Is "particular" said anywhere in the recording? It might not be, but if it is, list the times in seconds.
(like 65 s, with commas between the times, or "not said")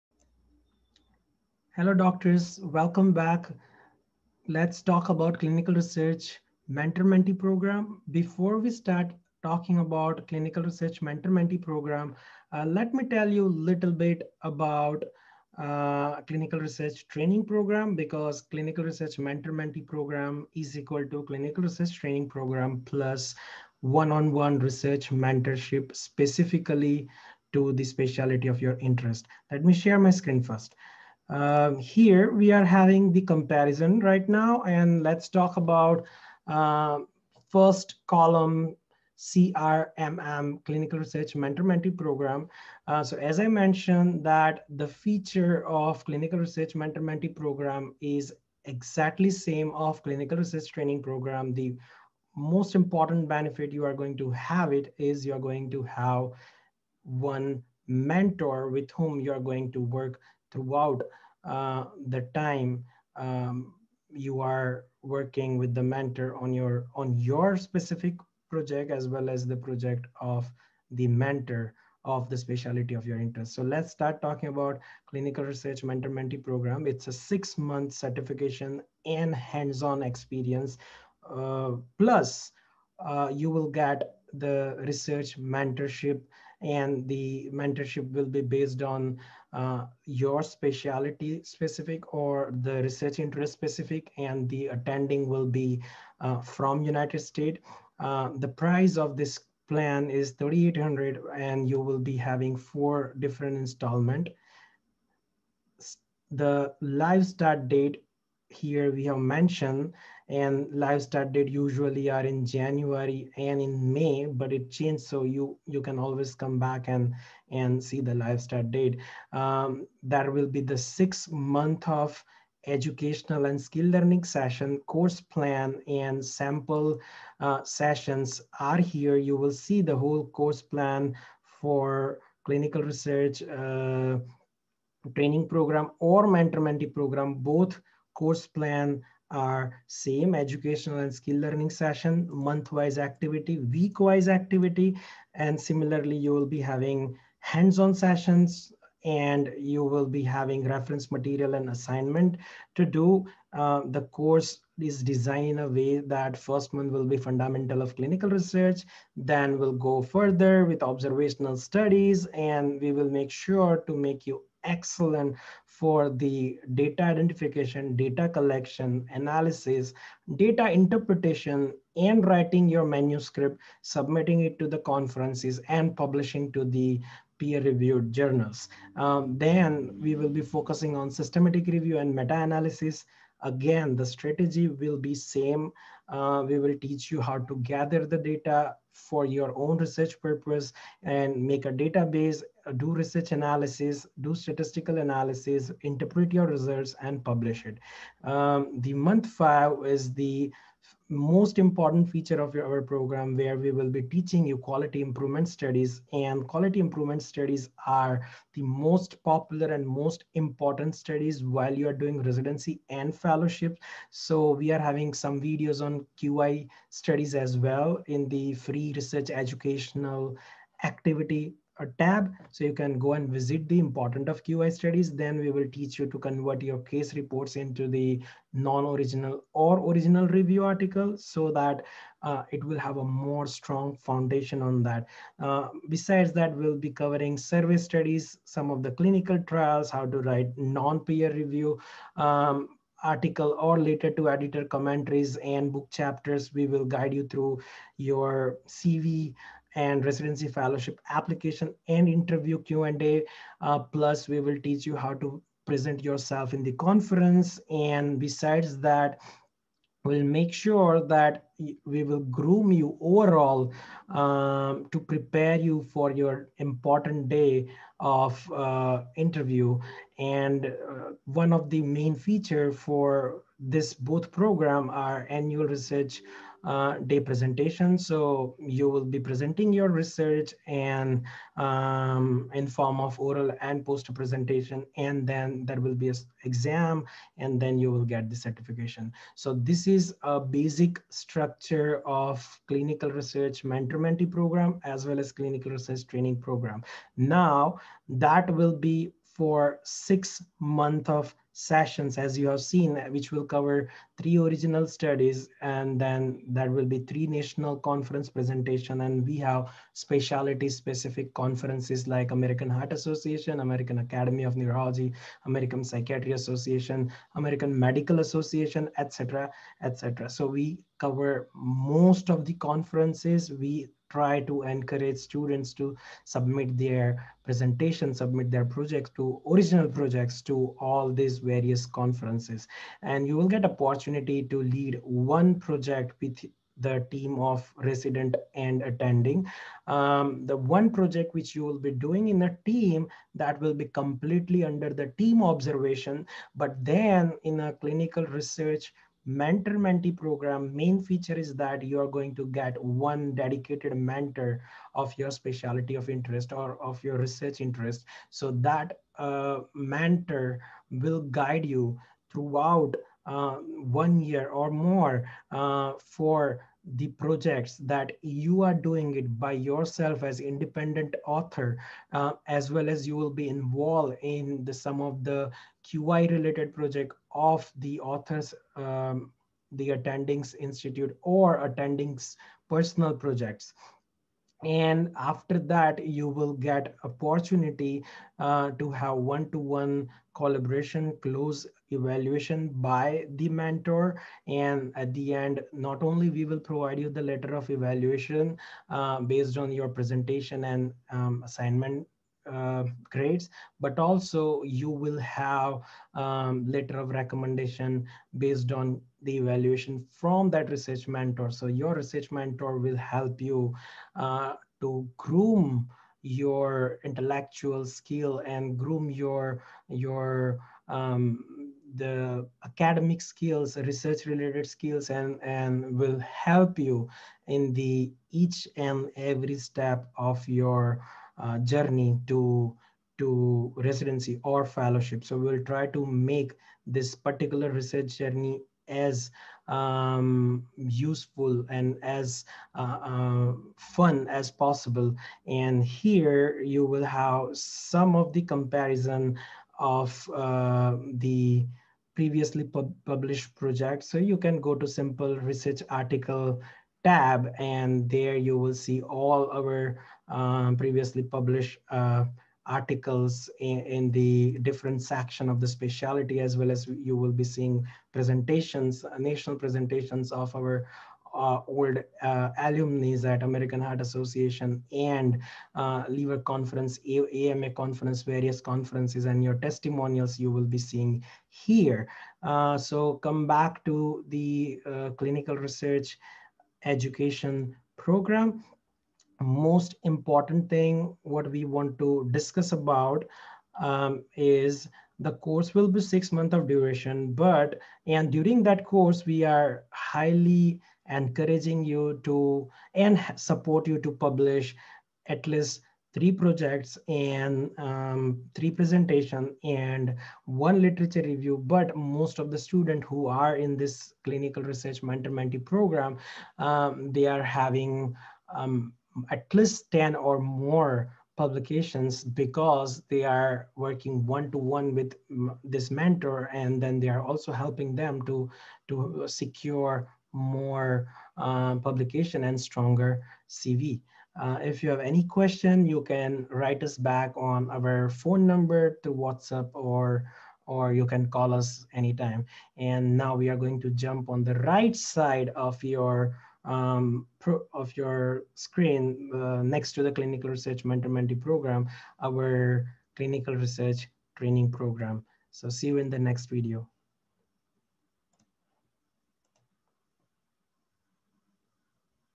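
437 s.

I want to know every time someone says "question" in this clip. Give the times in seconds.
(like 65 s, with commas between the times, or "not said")
535 s.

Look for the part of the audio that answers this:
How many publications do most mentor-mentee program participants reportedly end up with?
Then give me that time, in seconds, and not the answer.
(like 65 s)
519 s.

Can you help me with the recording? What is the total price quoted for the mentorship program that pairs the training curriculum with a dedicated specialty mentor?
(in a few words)
3800.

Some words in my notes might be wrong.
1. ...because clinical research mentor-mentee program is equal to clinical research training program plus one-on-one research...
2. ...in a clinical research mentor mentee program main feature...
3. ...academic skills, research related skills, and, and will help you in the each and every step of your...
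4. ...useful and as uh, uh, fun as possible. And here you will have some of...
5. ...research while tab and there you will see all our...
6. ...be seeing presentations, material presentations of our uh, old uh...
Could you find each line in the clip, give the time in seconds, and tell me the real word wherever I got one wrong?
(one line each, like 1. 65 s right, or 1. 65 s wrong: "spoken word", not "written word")
1. 17 s right
2. 347 s right
3. 422 s right
4. 440 s right
5. 455 s wrong: "article", not "while"
6. 467 s wrong: "national", not "material".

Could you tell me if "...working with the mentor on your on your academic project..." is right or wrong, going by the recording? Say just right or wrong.
wrong.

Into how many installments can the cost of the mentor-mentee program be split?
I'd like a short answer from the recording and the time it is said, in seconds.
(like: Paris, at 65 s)
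4, at 102 s.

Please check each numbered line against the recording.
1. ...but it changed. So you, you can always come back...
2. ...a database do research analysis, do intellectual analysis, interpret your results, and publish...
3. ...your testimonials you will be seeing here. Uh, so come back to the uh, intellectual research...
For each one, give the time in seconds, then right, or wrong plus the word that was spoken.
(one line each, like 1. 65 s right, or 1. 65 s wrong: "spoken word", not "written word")
1. 114 s right
2. 191 s wrong: "statistical", not "intellectual"
3. 479 s wrong: "clinical", not "intellectual".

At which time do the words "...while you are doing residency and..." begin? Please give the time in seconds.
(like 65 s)
211 s.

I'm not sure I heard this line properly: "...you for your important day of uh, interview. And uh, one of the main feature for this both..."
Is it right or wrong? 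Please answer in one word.
right.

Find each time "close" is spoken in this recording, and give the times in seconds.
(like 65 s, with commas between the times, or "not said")
391 s.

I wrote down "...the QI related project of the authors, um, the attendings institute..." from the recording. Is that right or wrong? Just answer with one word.
right.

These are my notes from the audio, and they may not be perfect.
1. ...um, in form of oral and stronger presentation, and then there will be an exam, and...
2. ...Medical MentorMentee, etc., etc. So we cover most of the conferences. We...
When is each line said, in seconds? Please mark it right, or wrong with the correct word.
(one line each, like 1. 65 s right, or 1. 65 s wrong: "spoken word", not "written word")
1. 281 s wrong: "poster", not "stronger"
2. 317 s wrong: "Association", not "MentorMentee".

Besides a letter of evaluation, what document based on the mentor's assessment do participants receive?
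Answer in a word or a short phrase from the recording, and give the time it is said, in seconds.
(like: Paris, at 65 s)
Letter of recommendation, at 406 s.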